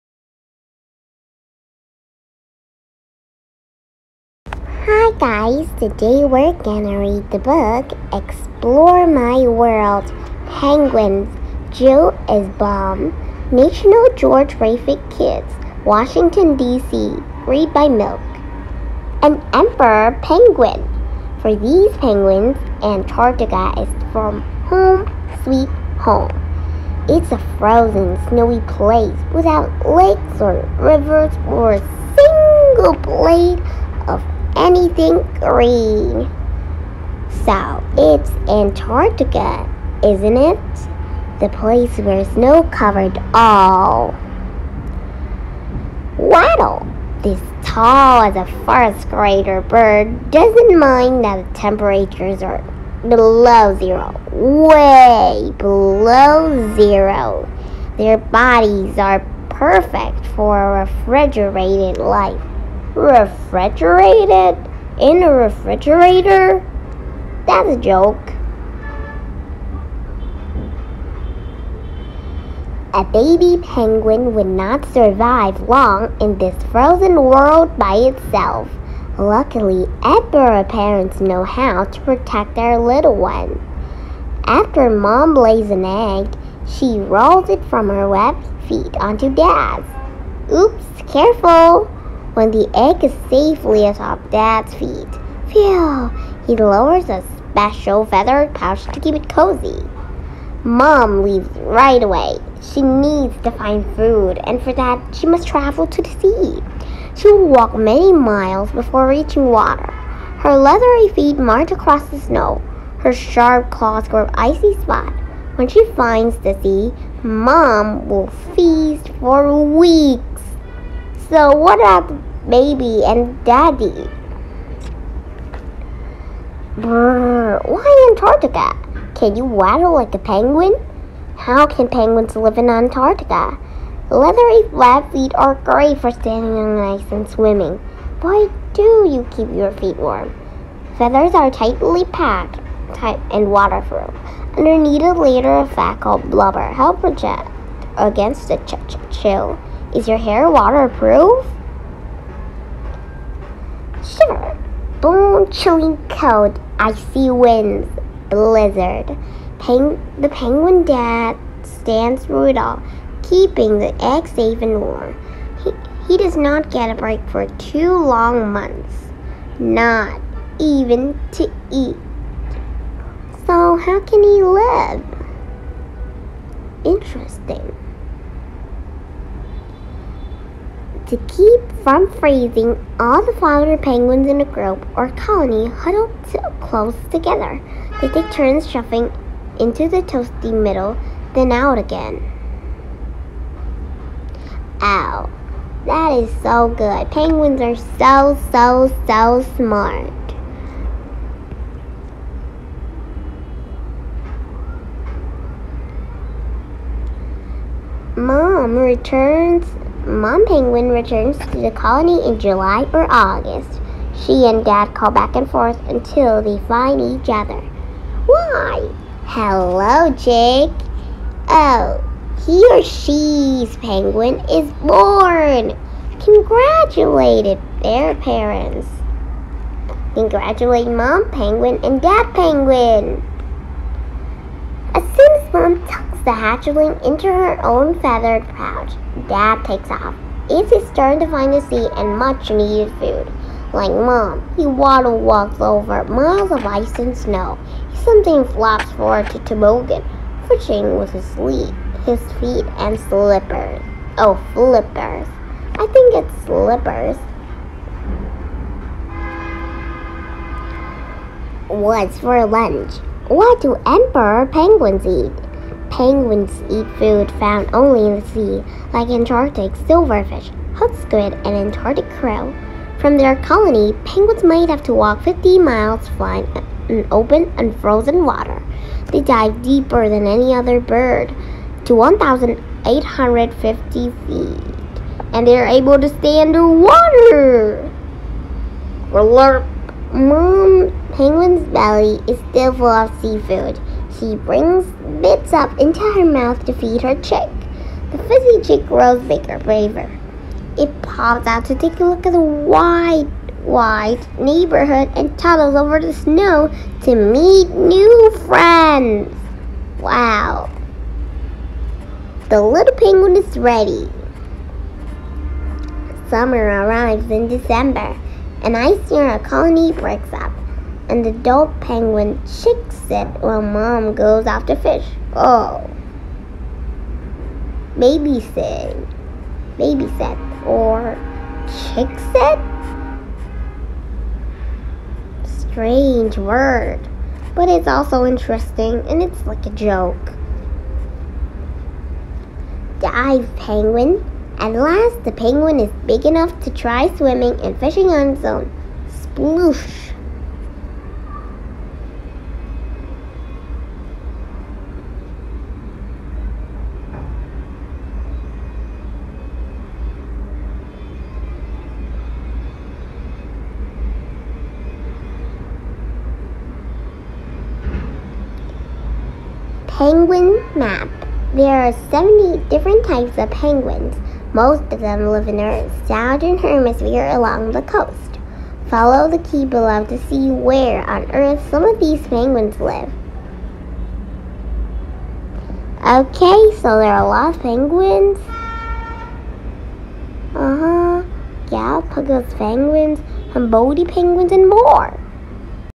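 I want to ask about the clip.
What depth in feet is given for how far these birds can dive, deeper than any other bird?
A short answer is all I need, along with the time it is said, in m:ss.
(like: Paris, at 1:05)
1,850 feet, at 4:41.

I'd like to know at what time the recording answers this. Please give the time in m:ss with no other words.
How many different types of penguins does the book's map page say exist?
6:12.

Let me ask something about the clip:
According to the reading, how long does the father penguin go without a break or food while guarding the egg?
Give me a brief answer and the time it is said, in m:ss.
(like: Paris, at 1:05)
2 months, at 2:47.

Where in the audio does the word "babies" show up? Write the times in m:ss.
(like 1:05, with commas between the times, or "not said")
not said.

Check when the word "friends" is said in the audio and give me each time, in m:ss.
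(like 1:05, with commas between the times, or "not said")
5:08.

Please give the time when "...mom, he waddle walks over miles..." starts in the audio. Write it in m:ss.
4:03.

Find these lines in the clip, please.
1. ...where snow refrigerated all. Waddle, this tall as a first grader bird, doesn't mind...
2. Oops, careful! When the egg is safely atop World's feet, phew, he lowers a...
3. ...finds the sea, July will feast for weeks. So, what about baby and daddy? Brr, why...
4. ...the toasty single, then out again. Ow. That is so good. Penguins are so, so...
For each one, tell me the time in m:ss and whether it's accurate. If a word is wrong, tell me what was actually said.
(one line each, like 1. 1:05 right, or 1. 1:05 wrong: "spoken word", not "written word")
1. 0:41 wrong: "covered", not "refrigerated"
2. 1:30 wrong: "Dad", not "World"
3. 1:55 wrong: "Mom", not "July"
4. 3:09 wrong: "middle", not "single".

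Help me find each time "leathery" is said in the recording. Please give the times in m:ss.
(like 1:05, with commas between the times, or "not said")
1:50, 2:14.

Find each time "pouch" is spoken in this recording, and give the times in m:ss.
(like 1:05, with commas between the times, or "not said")
1:38, 3:58.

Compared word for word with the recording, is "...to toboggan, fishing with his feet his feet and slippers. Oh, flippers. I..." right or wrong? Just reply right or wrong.
right.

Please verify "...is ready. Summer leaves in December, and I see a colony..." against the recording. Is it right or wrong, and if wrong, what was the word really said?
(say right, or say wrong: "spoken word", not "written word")
wrong: "arrives", not "leaves".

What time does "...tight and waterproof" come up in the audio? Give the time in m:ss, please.
2:22.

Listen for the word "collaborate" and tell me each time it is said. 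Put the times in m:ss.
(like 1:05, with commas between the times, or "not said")
not said.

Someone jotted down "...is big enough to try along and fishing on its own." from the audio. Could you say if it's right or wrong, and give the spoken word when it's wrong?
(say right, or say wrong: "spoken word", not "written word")
wrong: "swimming", not "along".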